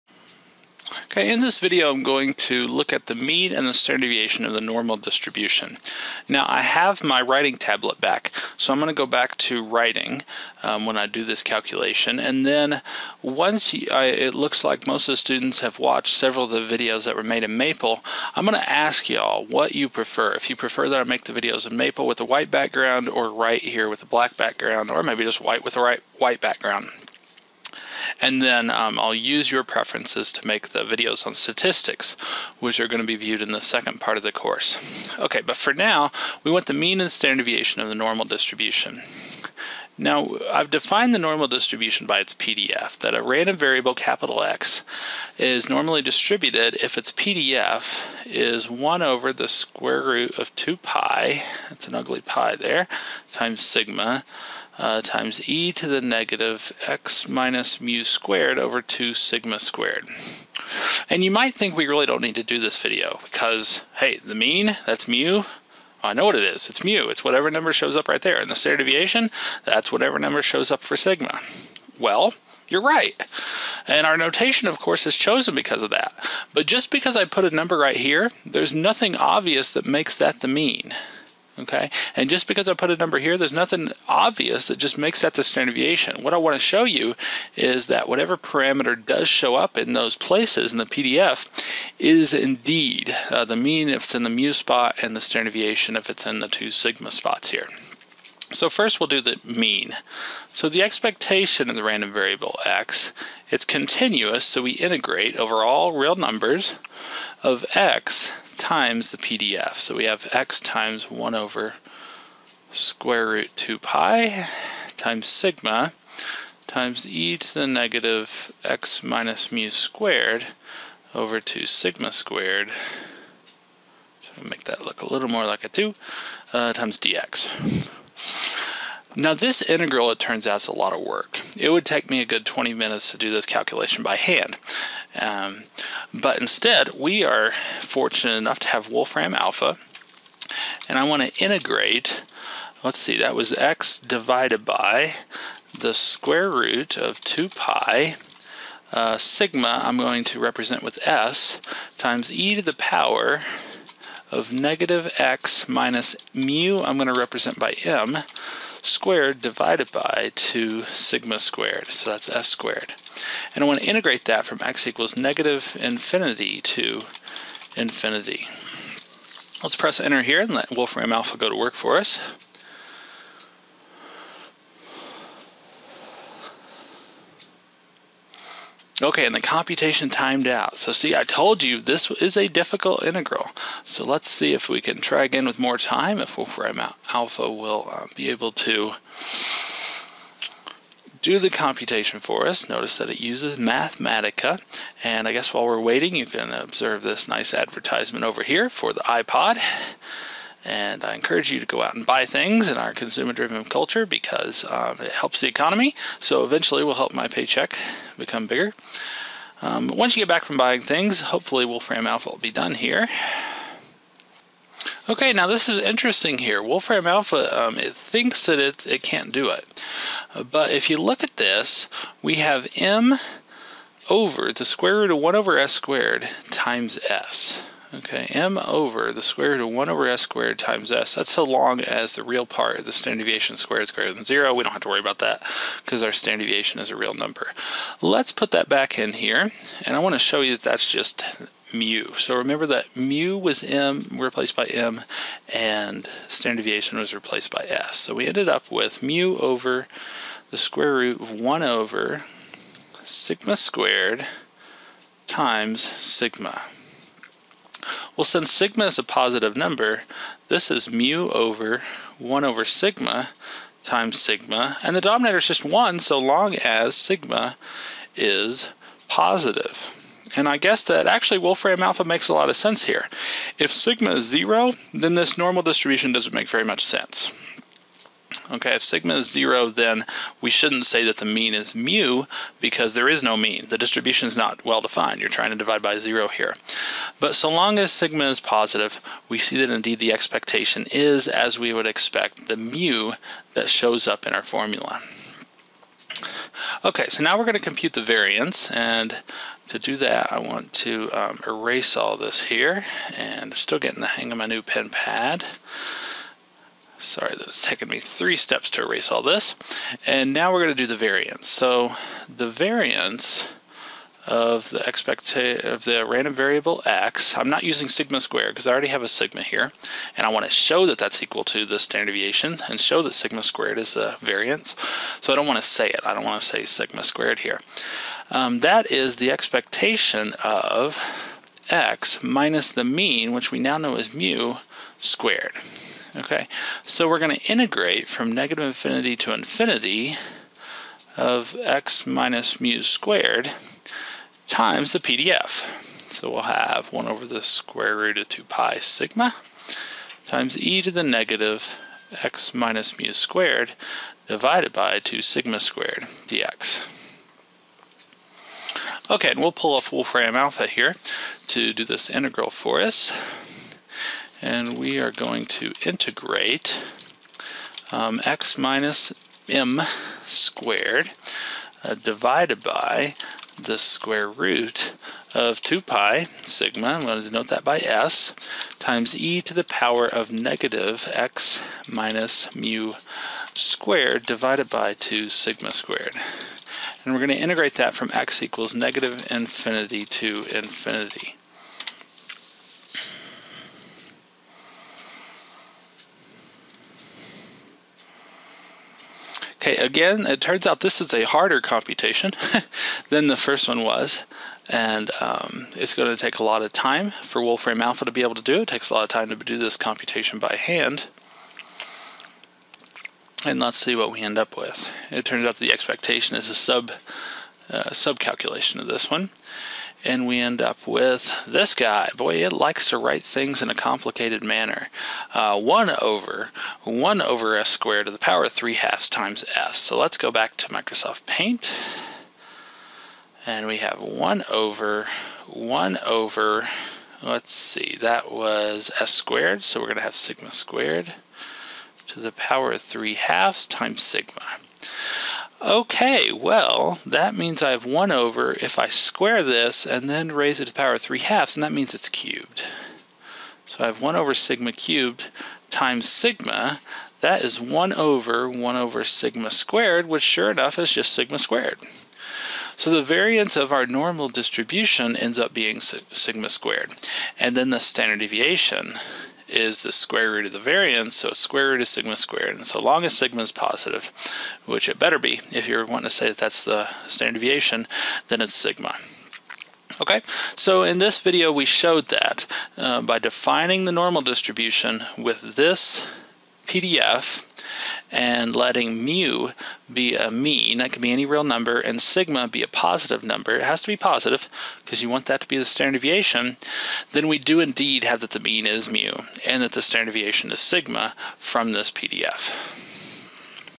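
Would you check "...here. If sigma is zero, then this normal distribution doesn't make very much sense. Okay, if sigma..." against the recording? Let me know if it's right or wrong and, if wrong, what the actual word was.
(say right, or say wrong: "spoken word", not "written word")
right.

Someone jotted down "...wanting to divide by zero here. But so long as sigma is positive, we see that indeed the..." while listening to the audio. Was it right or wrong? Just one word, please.
wrong.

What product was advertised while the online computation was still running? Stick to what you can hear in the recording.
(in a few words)
iPod.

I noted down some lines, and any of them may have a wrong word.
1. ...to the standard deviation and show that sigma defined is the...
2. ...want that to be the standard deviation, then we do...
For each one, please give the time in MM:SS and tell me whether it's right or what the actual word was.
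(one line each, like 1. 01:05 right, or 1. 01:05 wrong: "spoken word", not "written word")
1. 05:21 wrong: "squared", not "defined"
2. 08:15 right.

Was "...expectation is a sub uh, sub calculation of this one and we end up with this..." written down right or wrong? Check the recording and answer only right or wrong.
right.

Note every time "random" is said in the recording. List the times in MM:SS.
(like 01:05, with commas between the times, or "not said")
00:43, 01:41, 05:16.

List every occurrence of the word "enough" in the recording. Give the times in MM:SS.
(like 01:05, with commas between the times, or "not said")
02:18, 07:40.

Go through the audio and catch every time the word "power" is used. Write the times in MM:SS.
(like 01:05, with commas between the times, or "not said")
02:32, 06:19, 07:08, 07:22, 07:30.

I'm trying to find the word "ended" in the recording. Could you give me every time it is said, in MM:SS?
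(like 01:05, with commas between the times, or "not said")
04:08.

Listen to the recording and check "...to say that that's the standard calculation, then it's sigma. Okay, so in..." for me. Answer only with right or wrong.
wrong.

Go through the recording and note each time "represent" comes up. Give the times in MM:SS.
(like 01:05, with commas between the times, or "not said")
02:30, 02:37.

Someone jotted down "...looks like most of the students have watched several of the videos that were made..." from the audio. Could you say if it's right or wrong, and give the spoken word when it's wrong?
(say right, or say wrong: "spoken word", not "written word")
right.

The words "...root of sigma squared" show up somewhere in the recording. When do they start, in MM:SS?
07:51.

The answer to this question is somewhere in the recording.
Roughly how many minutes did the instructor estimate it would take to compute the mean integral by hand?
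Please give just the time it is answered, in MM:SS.
02:12.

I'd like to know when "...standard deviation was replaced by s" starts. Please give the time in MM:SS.
04:06.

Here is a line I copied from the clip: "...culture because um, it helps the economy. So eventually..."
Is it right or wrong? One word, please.
right.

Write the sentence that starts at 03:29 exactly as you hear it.
Um, once you get back from buying things, hopefully, Wolfram Alpha will be done here.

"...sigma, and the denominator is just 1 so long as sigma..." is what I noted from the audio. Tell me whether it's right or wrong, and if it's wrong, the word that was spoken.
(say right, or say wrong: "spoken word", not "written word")
right.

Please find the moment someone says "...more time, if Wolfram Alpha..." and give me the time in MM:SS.
03:05.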